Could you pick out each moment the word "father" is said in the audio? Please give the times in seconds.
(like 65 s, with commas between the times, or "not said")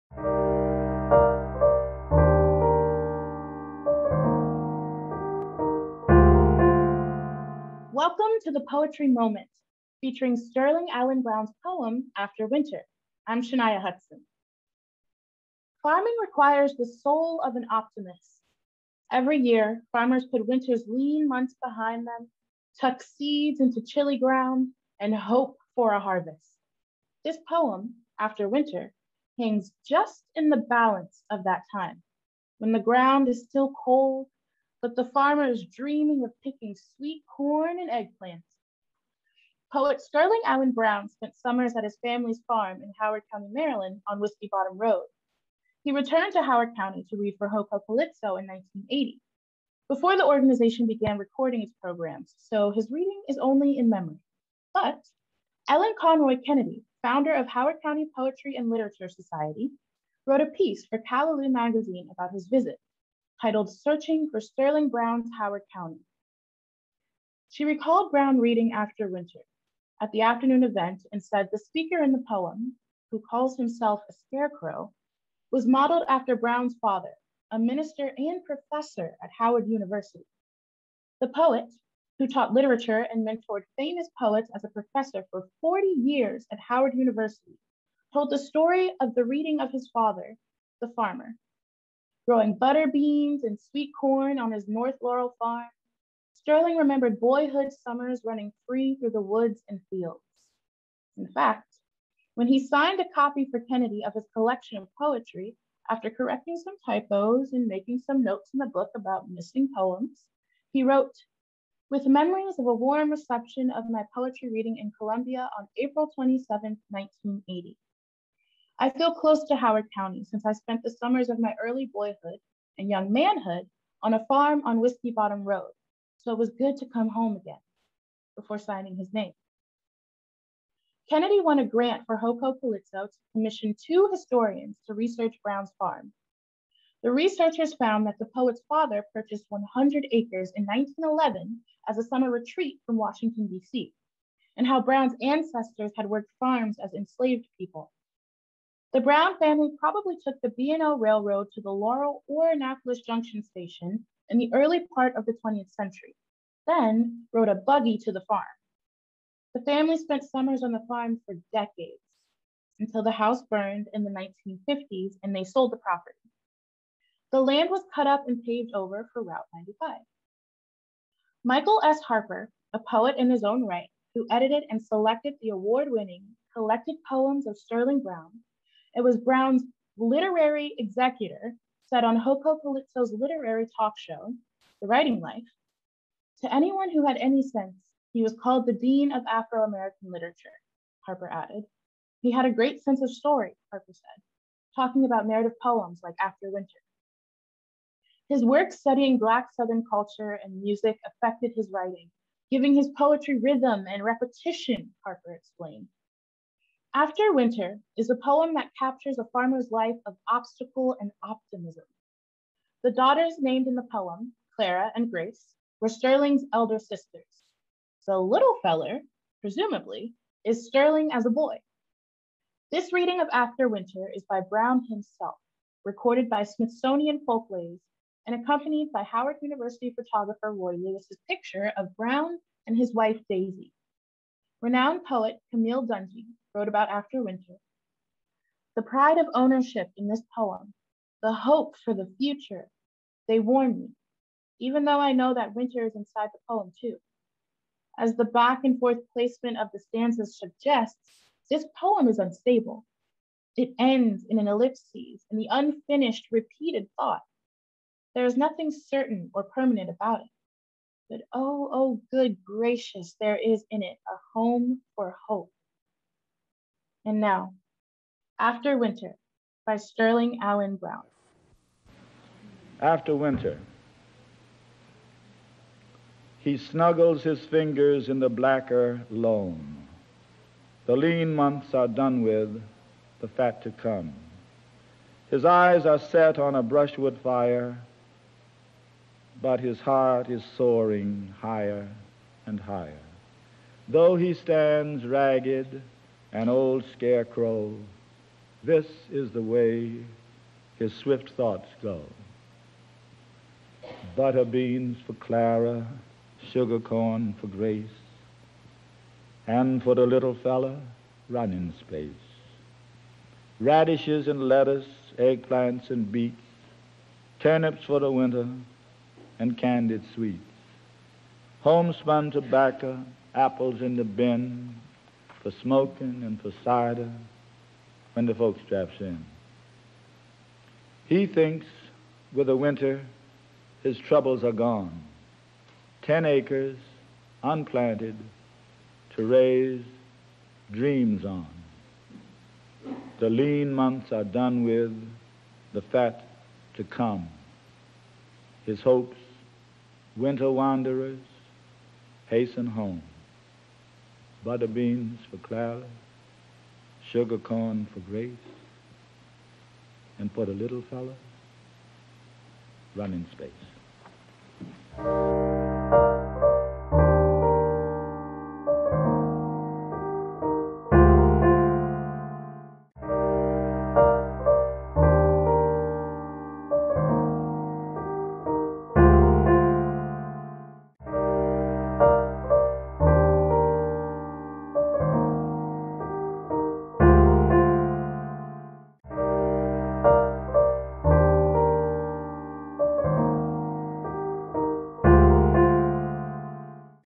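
76 s, 89 s, 138 s.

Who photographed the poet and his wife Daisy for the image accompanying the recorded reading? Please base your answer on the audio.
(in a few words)
Roy Lewis.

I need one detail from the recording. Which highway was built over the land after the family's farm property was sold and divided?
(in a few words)
Route 95.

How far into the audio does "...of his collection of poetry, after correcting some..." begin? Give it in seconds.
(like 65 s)
104 s.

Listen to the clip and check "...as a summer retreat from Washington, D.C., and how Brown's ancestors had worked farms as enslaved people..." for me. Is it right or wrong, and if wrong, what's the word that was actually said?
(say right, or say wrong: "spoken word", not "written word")
right.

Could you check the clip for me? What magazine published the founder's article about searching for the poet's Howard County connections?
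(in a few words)
Callaloo.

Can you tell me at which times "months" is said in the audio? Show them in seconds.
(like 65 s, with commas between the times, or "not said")
21 s, 281 s, 343 s.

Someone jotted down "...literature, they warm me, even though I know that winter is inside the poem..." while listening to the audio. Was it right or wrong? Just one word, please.
wrong.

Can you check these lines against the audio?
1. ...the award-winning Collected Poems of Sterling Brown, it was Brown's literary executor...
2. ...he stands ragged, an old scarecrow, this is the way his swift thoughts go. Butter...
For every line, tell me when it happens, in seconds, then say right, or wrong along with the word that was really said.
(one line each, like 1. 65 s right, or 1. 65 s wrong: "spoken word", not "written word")
1. 175 s right
2. 294 s right.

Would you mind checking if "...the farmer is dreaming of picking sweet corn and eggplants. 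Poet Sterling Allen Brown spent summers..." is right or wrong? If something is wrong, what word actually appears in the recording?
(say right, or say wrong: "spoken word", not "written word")
right.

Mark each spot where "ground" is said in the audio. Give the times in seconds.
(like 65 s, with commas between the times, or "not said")
24 s, 32 s.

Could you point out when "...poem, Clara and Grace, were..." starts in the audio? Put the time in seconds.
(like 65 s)
213 s.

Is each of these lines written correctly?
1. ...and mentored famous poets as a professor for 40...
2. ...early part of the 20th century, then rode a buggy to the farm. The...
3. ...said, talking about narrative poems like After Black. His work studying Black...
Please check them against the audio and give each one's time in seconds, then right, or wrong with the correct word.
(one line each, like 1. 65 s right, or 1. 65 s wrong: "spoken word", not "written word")
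1. 83 s right
2. 154 s right
3. 193 s wrong: "Winter", not "Black".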